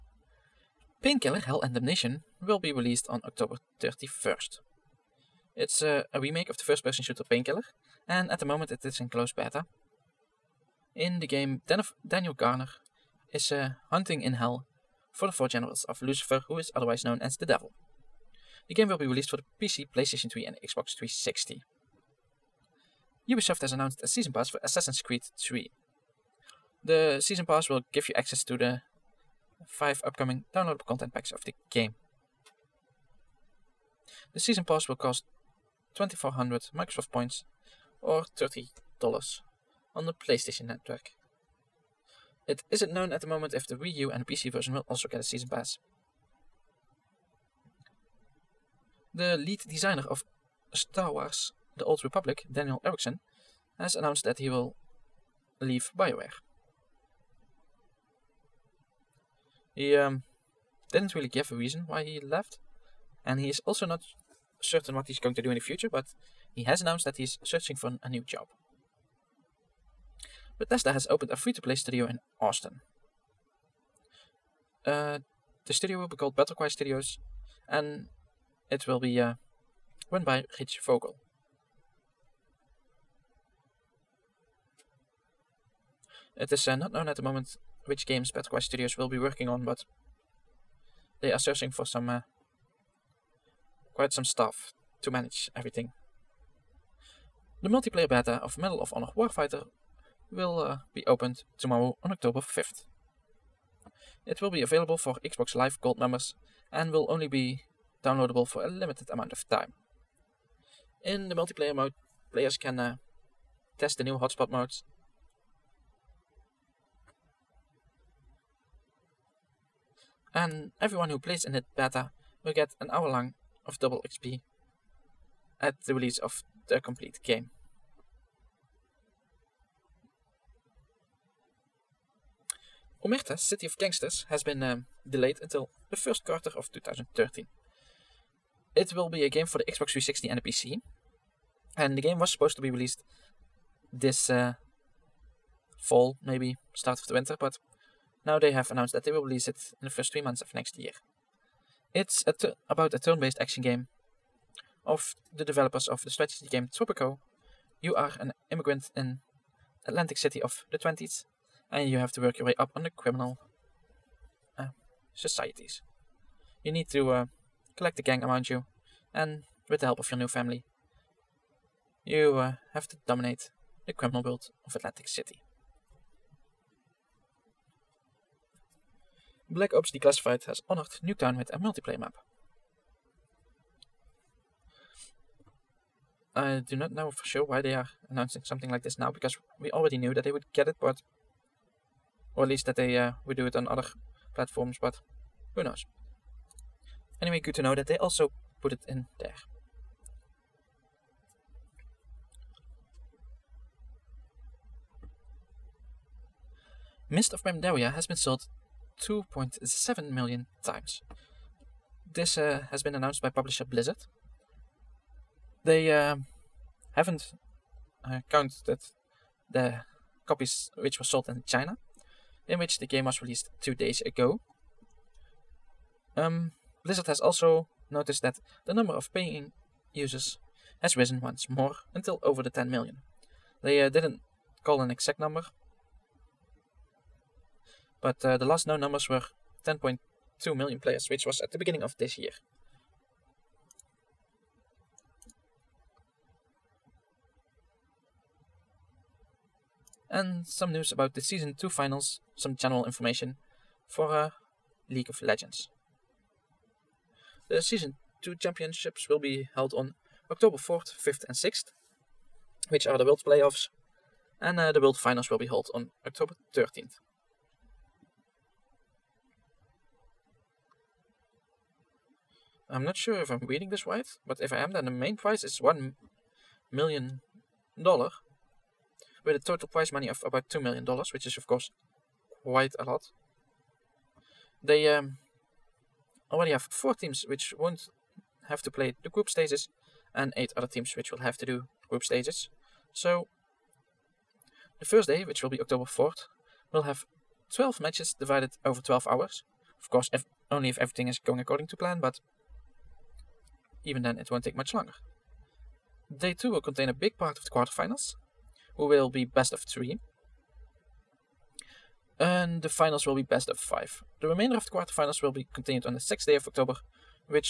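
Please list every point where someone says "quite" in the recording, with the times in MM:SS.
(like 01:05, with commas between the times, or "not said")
01:33, 04:42.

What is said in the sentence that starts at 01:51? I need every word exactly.
In the multiplayer mode, players can uh, test the new hotspot modes.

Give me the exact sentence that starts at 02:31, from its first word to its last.
It's a about a turn-based action game of the developers of the strategy game Tropico.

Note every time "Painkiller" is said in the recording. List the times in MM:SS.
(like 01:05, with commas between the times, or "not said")
00:01, 00:07.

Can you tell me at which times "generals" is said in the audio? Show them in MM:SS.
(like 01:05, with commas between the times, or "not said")
00:15, 04:12.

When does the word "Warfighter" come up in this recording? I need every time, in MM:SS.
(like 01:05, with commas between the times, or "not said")
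01:39.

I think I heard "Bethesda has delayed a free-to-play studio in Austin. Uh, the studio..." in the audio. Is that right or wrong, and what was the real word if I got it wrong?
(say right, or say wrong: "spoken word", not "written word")
wrong: "opened", not "delayed".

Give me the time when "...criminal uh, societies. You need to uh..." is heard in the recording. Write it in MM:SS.
02:42.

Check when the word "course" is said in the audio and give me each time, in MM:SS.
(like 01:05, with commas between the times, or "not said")
04:41, 04:59.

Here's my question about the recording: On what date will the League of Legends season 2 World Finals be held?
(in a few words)
October 13th.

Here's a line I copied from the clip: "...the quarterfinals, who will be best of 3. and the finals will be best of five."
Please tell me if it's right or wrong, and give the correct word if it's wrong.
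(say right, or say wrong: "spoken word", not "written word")
right.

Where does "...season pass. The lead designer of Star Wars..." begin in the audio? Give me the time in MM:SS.
00:45.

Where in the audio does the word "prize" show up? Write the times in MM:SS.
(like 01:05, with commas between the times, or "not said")
04:35, 04:39.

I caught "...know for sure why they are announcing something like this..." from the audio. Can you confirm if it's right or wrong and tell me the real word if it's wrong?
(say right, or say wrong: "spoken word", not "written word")
right.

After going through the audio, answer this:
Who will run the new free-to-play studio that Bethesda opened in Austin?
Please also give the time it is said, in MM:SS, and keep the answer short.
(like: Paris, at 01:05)
Rich Vogel, at 01:20.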